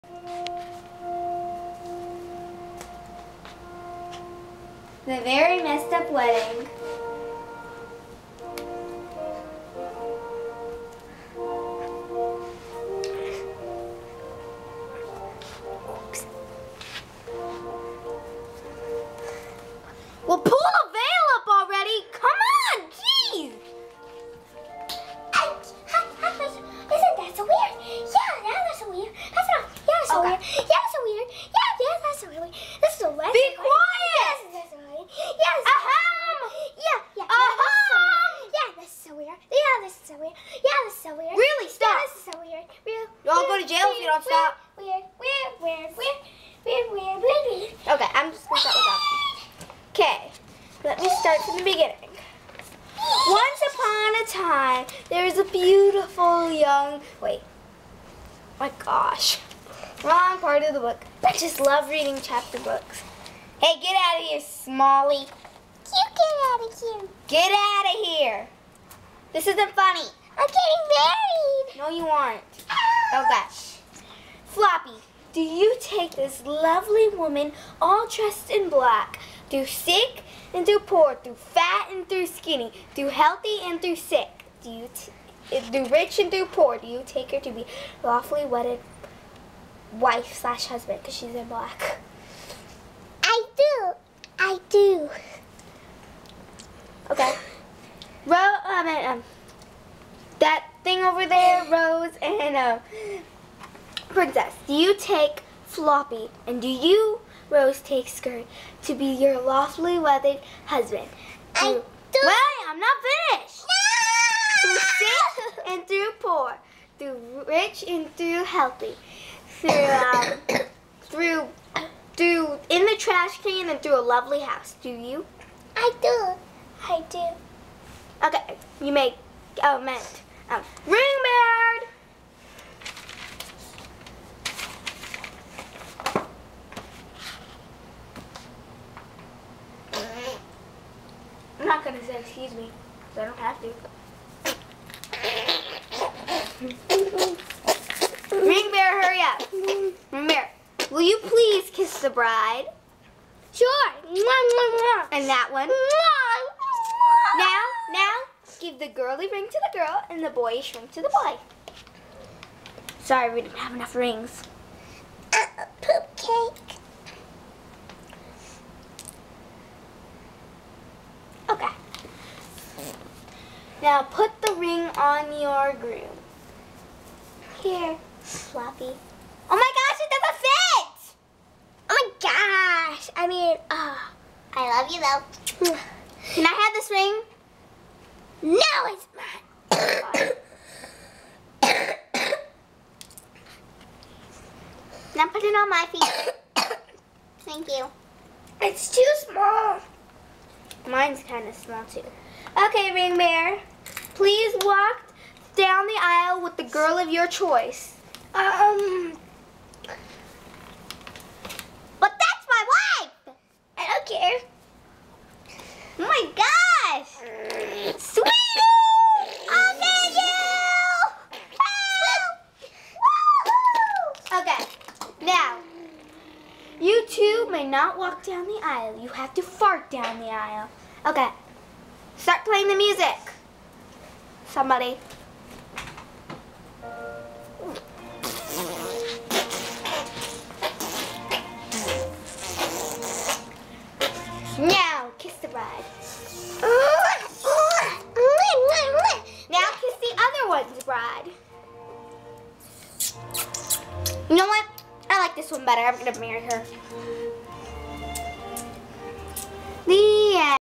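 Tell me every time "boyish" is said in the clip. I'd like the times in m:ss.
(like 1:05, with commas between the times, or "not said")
2:40.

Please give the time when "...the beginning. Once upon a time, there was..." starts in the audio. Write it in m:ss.
0:51.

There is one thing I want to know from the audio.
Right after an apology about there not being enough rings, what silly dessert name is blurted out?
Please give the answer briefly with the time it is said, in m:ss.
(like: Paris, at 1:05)
poop cake, at 2:45.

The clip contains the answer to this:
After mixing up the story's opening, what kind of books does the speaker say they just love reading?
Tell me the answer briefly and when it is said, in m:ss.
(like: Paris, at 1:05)
chapter books, at 1:02.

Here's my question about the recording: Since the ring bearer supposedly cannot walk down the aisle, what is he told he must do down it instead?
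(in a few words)
fart.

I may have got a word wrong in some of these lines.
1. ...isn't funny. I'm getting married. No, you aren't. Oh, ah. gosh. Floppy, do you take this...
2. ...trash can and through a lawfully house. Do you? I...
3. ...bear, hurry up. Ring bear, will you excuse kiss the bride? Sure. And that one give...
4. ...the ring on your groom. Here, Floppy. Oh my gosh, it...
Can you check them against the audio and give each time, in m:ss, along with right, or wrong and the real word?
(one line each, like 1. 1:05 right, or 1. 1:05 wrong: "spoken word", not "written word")
1. 1:09 right
2. 2:02 wrong: "lovely", not "lawfully"
3. 2:28 wrong: "please", not "excuse"
4. 2:54 right.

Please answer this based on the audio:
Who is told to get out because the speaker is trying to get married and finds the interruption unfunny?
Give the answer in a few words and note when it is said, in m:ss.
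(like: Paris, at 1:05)
Smalley, at 1:04.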